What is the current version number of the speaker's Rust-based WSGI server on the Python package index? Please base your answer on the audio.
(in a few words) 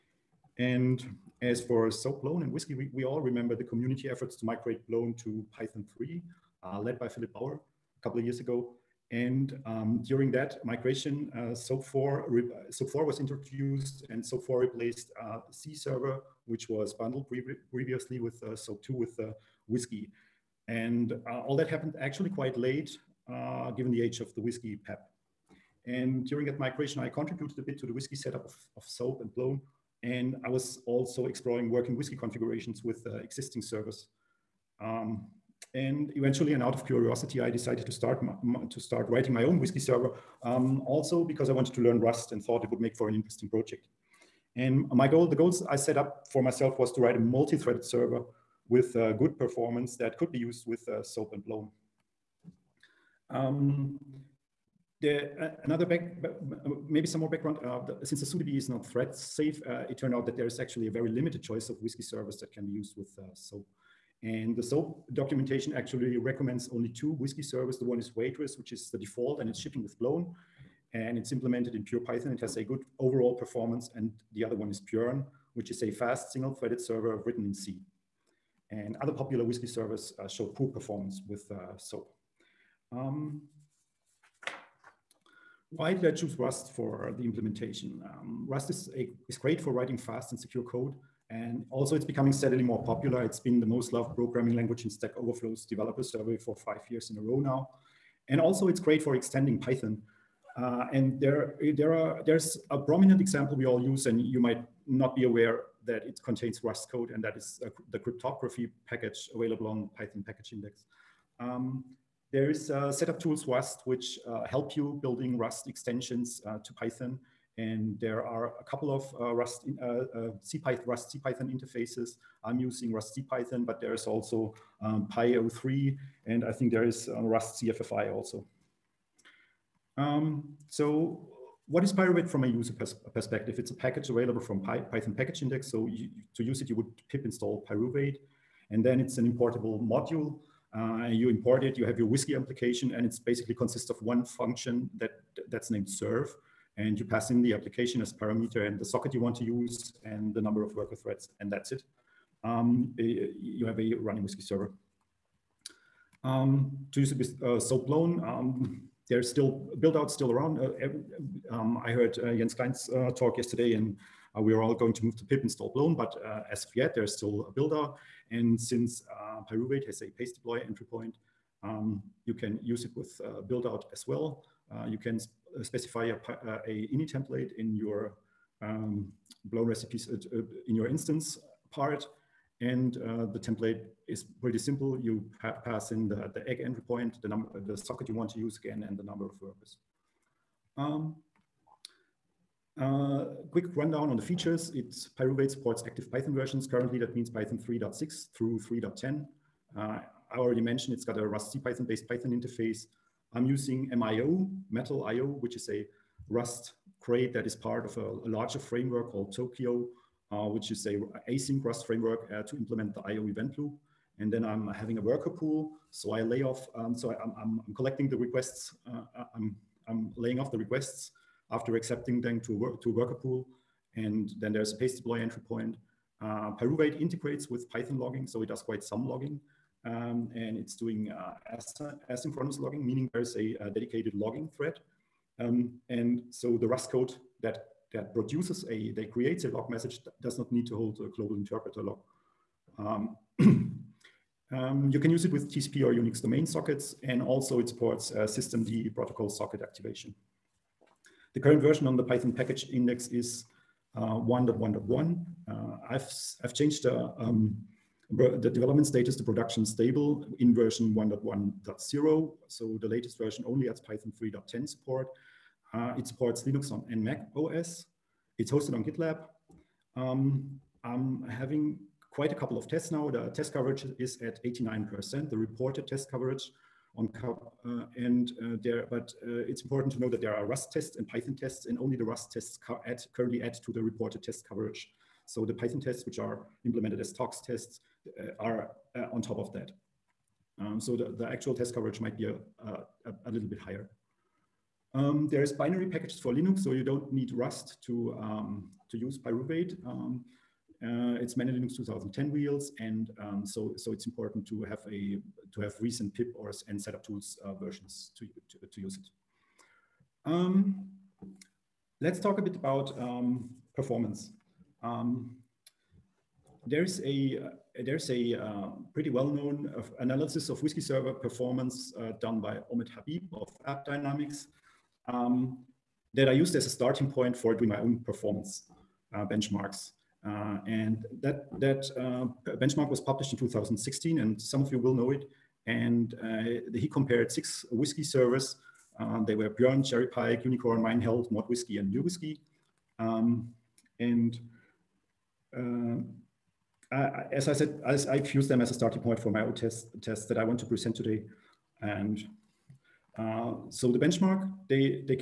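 1.1.1.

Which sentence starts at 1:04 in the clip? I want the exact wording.
And the Zope documentation actually recommends only two WSGI service.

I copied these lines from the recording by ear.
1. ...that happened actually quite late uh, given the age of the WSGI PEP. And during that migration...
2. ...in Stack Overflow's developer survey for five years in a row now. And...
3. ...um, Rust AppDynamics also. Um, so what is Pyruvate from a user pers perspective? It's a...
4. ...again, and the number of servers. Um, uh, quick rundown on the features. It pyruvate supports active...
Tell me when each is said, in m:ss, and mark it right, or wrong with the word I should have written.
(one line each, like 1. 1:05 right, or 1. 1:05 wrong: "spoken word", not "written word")
1. 0:21 right
2. 1:34 right
3. 2:07 wrong: "CFFI", not "AppDynamics"
4. 3:08 wrong: "workers", not "servers".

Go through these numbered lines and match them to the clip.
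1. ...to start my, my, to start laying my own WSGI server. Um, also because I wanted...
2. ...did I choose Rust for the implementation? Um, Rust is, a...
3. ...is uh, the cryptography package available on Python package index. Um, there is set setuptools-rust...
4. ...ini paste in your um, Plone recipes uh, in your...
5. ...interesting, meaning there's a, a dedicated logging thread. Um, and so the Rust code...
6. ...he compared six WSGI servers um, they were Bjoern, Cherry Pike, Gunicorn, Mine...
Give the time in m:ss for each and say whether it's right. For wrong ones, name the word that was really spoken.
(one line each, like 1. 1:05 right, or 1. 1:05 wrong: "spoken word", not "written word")
1. 0:37 wrong: "writing", not "laying"
2. 1:25 right
3. 1:47 right
4. 2:56 wrong: "template", not "paste"
5. 3:52 wrong: "logging", not "interesting"
6. 5:36 right.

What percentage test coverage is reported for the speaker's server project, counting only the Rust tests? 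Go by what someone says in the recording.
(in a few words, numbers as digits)
89%.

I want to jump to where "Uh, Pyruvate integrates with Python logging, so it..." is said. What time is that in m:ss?
3:46.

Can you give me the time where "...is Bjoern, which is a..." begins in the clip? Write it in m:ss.
1:14.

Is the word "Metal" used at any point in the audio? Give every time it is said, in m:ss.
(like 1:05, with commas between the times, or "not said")
3:24.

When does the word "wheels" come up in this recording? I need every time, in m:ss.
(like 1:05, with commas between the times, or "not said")
5:02.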